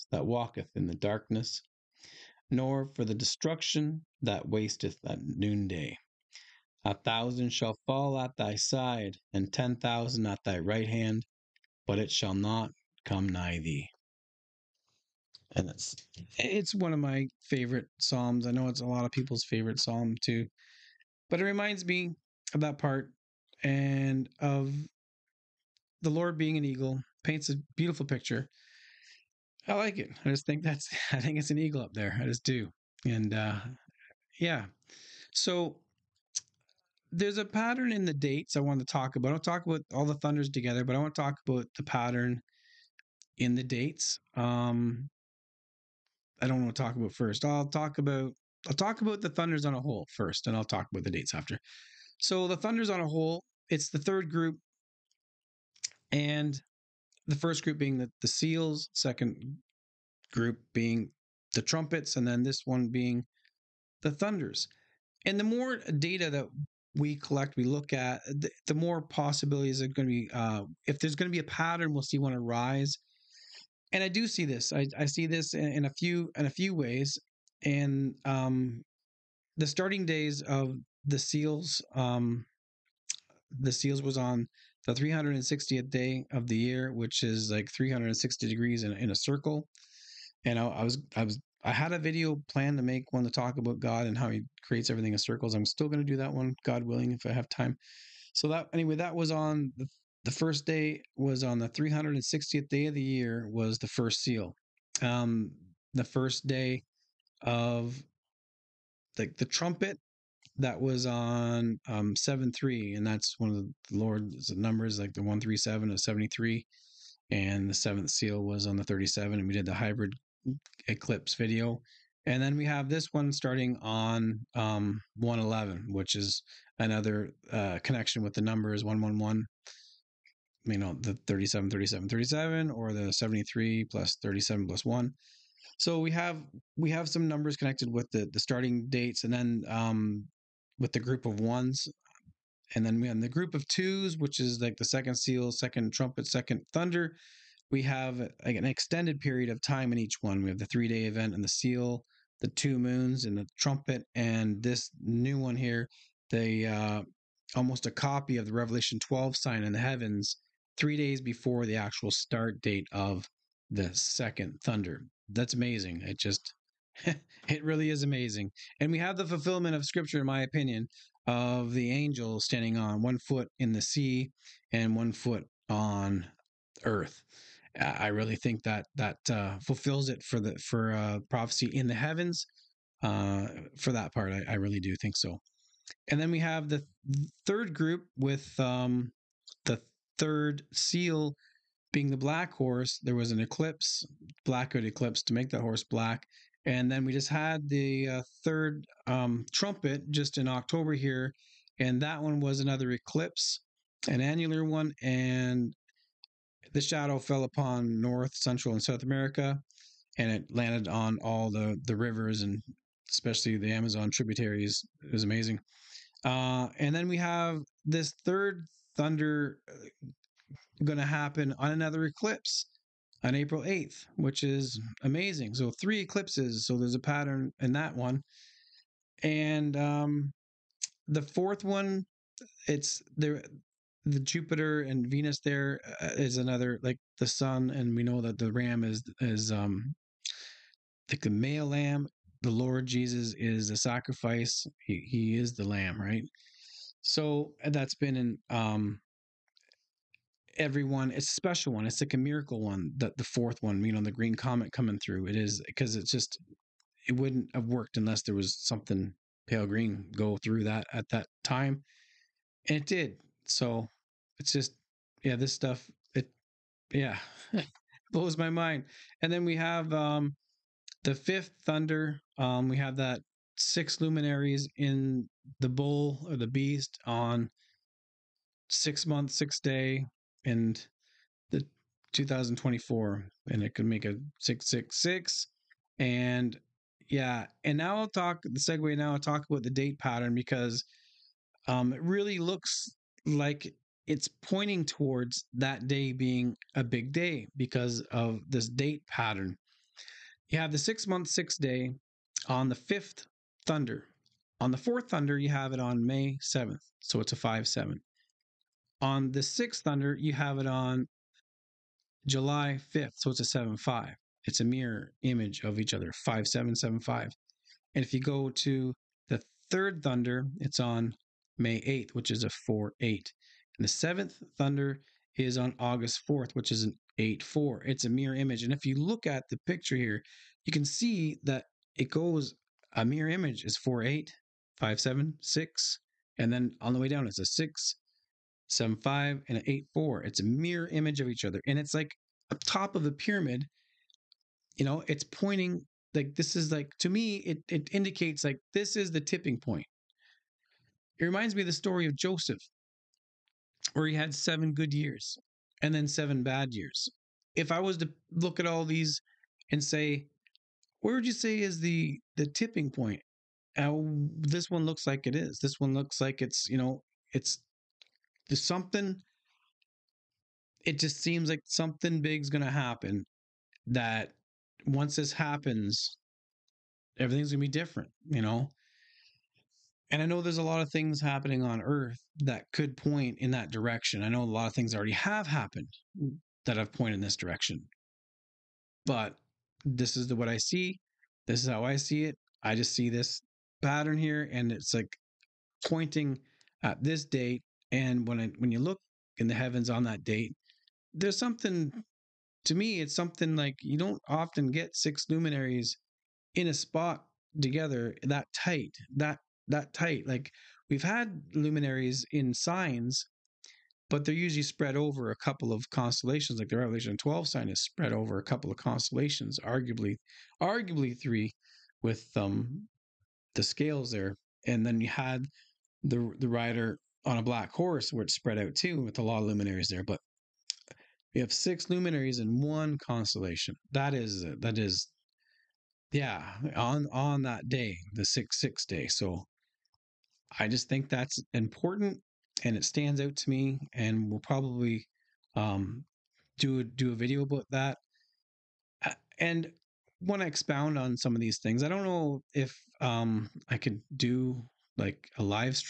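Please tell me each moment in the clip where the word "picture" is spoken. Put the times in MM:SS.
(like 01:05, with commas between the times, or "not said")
00:28, 05:29.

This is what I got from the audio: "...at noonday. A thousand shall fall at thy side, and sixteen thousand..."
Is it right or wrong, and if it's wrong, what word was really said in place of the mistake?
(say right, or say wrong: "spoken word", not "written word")
wrong: "ten", not "sixteen".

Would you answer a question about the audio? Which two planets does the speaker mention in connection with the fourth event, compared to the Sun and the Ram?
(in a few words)
Jupiter and Venus.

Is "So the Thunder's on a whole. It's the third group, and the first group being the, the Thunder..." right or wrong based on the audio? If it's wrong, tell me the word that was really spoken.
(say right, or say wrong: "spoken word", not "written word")
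wrong: "Seals", not "Thunder".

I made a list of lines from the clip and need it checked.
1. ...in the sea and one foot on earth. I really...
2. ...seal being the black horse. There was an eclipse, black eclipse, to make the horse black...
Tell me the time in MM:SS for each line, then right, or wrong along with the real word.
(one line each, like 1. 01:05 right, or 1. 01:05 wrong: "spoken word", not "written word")
1. 02:53 right
2. 03:10 right.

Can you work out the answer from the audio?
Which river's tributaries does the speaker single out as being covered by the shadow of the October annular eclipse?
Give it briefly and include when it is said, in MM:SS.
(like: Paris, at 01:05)
Amazon, at 03:33.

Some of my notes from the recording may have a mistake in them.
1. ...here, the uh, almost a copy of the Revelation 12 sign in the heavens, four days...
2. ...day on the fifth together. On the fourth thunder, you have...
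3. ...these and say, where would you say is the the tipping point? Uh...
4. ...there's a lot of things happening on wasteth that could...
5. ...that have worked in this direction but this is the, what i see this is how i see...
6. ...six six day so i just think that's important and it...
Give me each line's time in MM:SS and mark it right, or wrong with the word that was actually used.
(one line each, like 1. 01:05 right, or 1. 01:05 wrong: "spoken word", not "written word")
1. 02:35 wrong: "three", not "four"
2. 05:01 wrong: "thunder", not "together"
3. 05:58 right
4. 06:20 wrong: "earth", not "wasteth"
5. 06:26 wrong: "pointed", not "worked"
6. 07:18 right.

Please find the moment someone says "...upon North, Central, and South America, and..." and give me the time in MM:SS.
03:27.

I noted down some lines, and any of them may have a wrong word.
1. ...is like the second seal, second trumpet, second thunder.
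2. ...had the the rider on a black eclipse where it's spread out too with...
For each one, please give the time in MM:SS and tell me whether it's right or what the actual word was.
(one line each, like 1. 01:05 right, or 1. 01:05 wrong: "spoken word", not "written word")
1. 02:24 right
2. 07:05 wrong: "horse", not "eclipse".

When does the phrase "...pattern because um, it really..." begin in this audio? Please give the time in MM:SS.
04:49.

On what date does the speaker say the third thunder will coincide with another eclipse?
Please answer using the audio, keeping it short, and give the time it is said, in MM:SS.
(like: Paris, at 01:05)
April 8th, at 03:43.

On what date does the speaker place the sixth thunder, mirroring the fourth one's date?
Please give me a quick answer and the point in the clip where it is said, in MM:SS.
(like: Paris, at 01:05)
July 5th, at 05:12.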